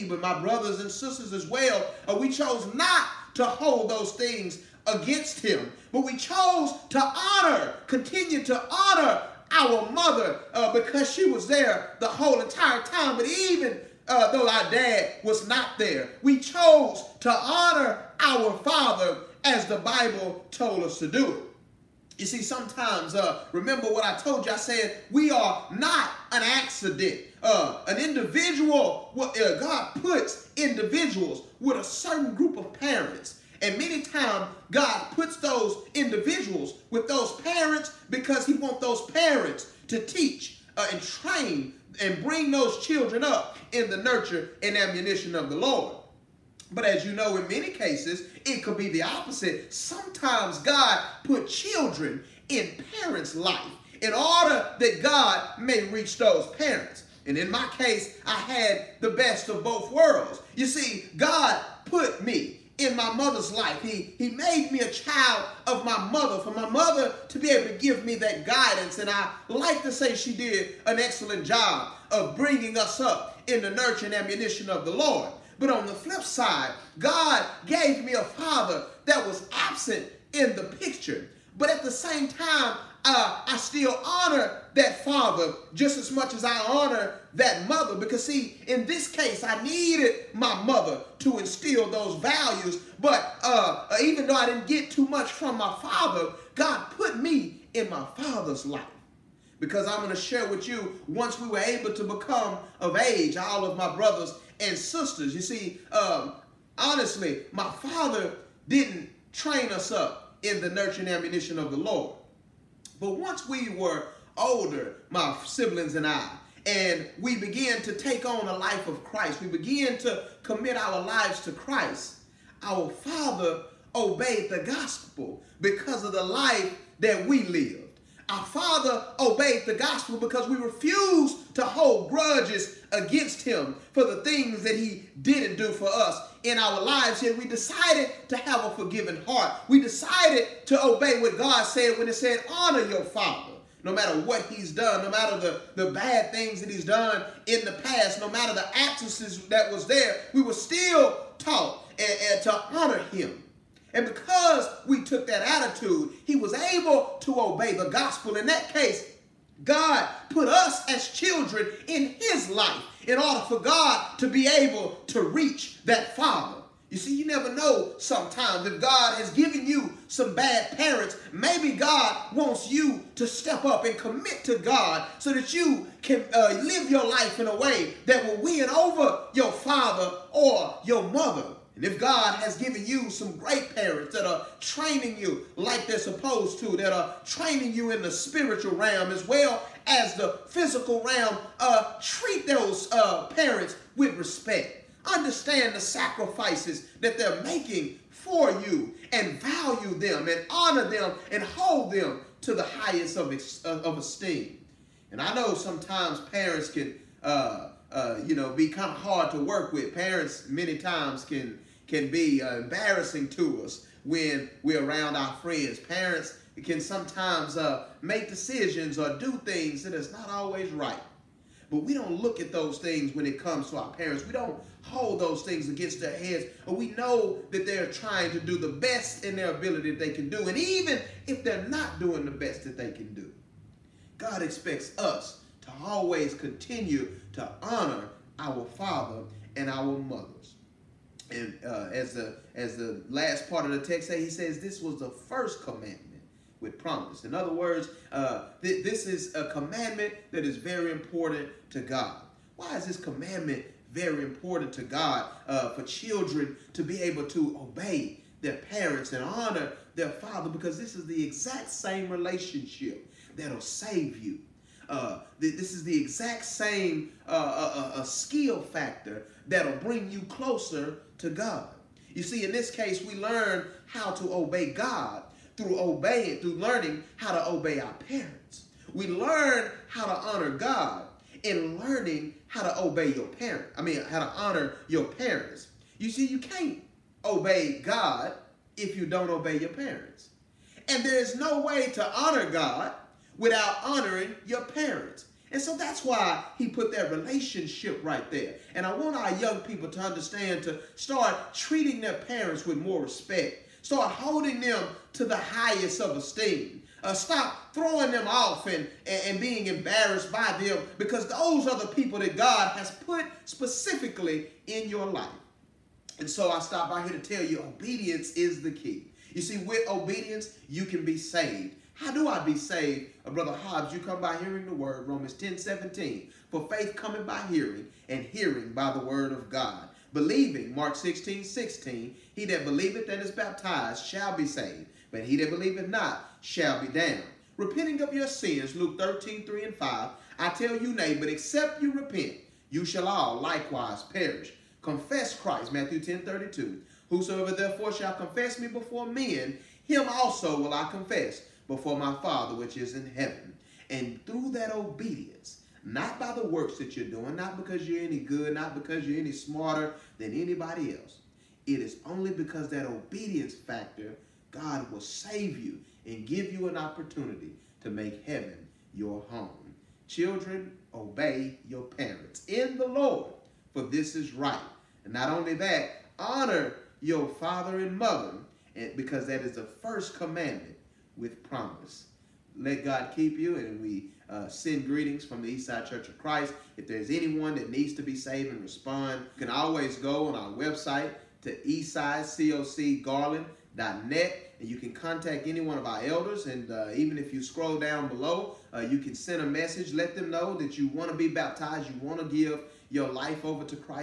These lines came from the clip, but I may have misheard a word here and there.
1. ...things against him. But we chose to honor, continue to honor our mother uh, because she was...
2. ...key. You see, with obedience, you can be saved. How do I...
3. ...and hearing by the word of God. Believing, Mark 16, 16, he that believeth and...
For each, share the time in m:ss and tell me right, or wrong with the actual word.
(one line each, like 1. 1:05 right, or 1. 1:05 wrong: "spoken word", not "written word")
1. 0:04 right
2. 5:18 right
3. 5:28 right.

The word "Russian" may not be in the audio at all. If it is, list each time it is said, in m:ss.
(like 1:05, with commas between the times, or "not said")
not said.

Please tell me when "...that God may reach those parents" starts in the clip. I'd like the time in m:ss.
0:54.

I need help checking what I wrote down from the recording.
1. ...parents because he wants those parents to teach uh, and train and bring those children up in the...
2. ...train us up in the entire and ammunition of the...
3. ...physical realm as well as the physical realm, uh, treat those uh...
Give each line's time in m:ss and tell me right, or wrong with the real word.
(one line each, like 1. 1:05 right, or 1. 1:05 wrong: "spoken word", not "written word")
1. 0:37 right
2. 1:49 wrong: "nurture", not "entire"
3. 3:08 wrong: "spiritual", not "physical".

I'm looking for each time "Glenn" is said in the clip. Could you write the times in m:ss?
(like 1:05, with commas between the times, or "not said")
not said.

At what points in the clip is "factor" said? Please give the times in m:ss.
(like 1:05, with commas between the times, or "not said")
4:28, 6:03.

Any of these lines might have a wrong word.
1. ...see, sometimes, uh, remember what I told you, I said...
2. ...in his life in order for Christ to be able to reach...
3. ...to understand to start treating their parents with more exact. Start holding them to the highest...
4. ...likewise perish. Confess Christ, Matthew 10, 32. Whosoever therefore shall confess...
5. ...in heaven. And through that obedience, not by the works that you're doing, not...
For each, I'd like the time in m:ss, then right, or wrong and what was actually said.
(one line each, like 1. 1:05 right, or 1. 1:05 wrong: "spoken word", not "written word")
1. 0:22 right
2. 2:41 wrong: "God", not "Christ"
3. 4:59 wrong: "respect", not "exact"
4. 5:43 right
5. 5:52 right.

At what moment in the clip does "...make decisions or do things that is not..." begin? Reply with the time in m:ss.
3:38.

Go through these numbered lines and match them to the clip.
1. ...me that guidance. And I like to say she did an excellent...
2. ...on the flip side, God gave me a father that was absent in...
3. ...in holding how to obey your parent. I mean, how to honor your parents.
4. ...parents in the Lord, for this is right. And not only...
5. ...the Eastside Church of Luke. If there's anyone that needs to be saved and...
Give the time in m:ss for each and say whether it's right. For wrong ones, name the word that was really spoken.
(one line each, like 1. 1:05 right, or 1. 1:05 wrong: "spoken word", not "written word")
1. 1:08 right
2. 1:15 right
3. 4:41 wrong: "learning", not "holding"
4. 6:11 right
5. 6:25 wrong: "Christ", not "Luke".